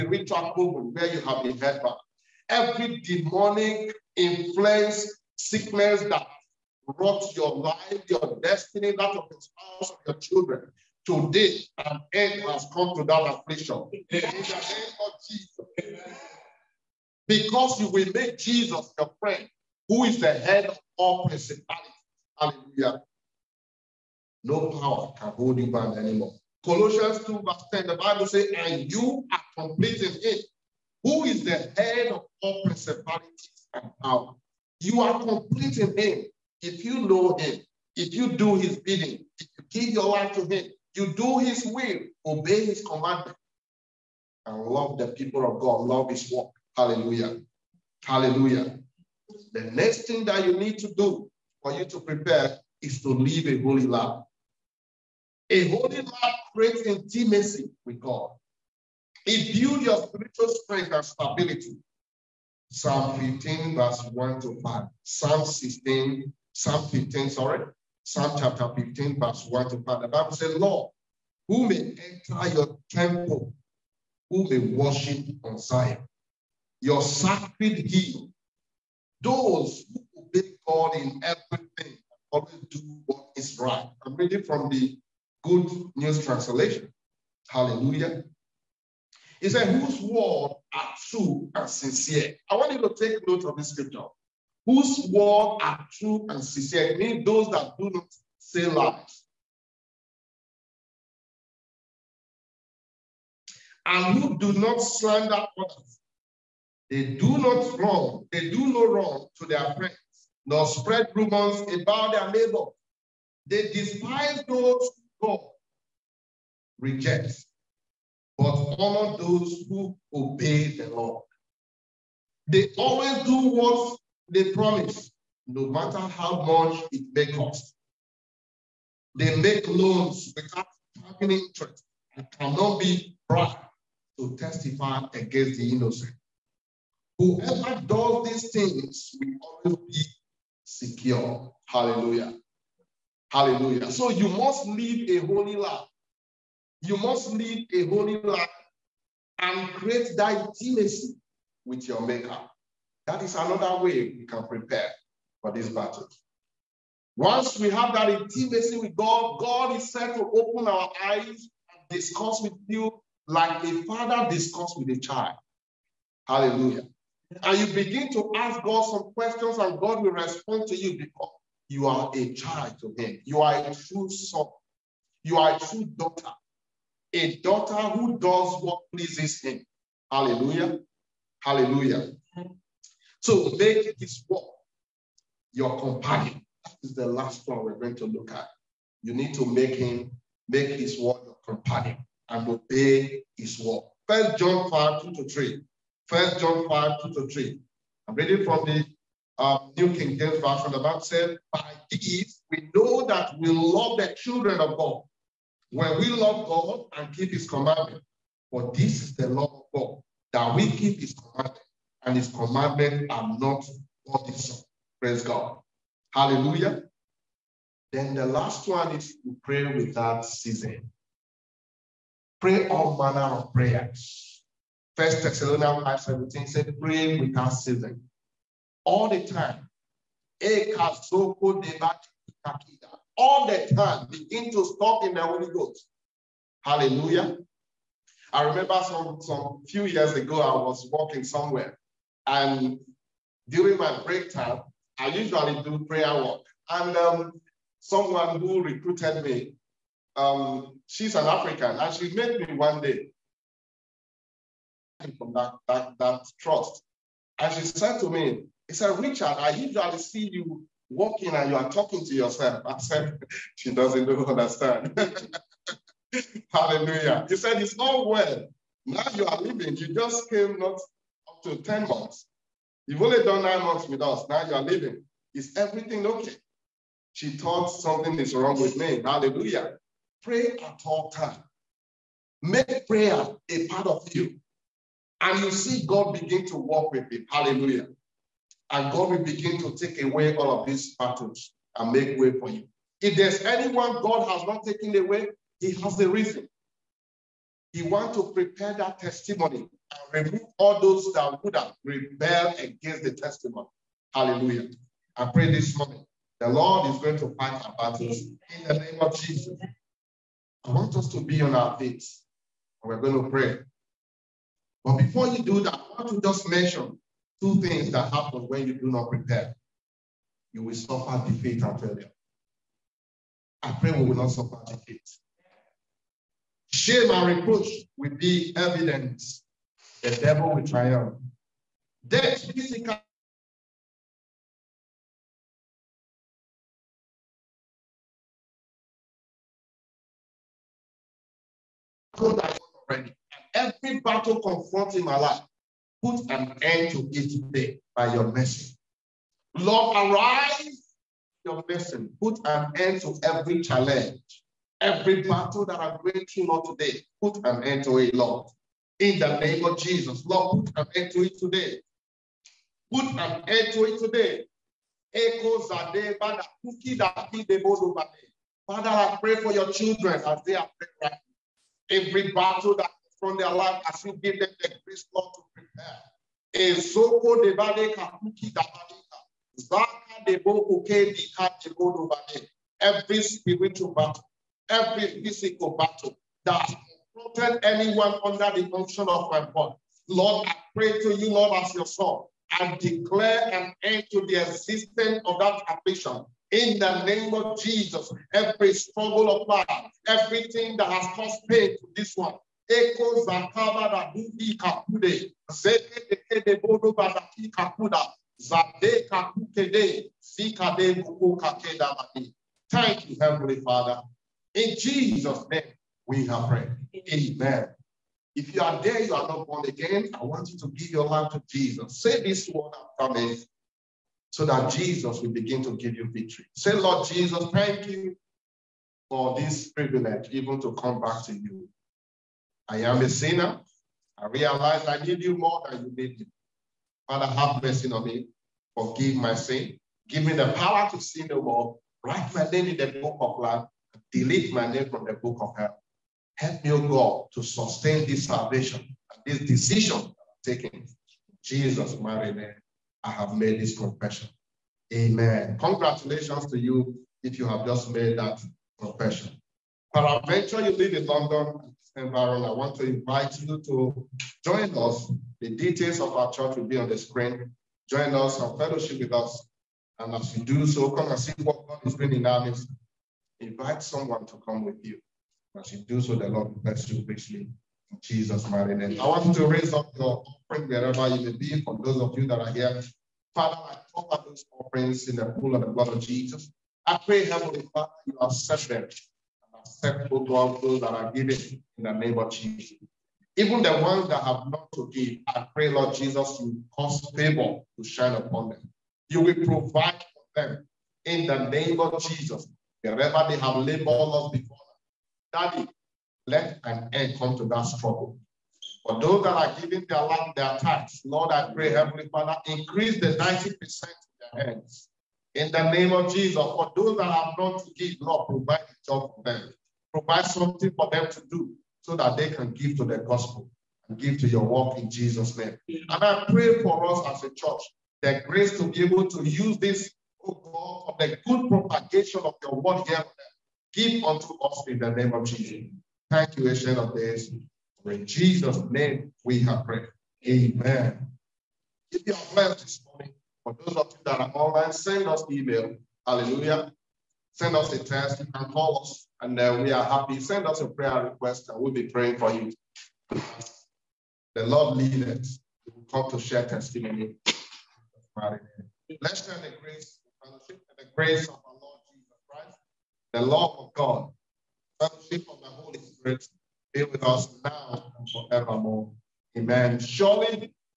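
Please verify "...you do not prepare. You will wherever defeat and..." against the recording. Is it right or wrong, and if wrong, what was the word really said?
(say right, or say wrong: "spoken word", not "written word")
wrong: "suffer", not "wherever".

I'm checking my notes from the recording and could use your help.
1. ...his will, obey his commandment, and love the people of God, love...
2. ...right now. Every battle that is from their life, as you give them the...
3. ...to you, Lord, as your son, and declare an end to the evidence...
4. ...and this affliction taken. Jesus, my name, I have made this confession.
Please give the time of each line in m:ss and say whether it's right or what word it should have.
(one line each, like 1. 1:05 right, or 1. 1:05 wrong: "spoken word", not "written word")
1. 0:41 right
2. 6:11 right
3. 6:30 wrong: "existence", not "evidence"
4. 7:29 wrong: "decision", not "affliction".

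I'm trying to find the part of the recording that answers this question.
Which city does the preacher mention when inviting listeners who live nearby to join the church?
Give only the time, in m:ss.
7:41.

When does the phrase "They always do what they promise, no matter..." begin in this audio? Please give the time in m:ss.
2:02.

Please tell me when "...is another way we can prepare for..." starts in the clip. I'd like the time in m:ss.
2:33.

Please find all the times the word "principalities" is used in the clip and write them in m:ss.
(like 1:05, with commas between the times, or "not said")
0:21, 0:32.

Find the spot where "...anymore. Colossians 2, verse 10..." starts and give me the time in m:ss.
0:25.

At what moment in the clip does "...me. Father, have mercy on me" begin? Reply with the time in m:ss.
7:16.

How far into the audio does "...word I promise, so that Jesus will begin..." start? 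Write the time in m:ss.
7:02.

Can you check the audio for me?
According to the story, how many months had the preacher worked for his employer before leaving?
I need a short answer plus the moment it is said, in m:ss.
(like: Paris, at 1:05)
9, at 4:33.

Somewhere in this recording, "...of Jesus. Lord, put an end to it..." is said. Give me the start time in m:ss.
5:59.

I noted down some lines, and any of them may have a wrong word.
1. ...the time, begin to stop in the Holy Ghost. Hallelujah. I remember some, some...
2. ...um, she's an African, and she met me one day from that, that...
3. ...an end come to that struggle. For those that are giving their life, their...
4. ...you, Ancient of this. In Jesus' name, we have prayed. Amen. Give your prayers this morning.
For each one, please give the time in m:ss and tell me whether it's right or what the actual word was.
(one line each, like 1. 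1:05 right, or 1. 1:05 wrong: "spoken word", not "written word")
1. 3:53 right
2. 4:10 right
3. 8:26 right
4. 8:56 right.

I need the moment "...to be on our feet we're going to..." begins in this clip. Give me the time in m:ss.
5:11.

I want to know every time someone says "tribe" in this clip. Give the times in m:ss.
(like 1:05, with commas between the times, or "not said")
not said.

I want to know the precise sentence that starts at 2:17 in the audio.
Whoever does these things will always be secure.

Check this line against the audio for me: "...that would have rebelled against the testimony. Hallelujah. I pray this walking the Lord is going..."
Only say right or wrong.
wrong.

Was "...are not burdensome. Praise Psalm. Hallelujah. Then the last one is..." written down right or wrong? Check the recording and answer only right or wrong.
wrong.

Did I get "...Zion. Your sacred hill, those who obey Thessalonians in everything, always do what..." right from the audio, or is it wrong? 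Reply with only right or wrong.
wrong.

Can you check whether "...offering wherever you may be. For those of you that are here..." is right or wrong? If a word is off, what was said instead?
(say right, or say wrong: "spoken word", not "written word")
right.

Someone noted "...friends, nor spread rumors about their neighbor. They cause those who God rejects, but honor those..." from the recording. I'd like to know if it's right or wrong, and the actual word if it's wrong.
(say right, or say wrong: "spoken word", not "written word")
wrong: "despise", not "cause".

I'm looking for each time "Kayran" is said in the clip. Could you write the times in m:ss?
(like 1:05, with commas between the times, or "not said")
not said.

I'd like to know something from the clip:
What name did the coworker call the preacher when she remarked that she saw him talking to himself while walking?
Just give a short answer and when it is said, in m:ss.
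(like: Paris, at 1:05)
Richard, at 4:18.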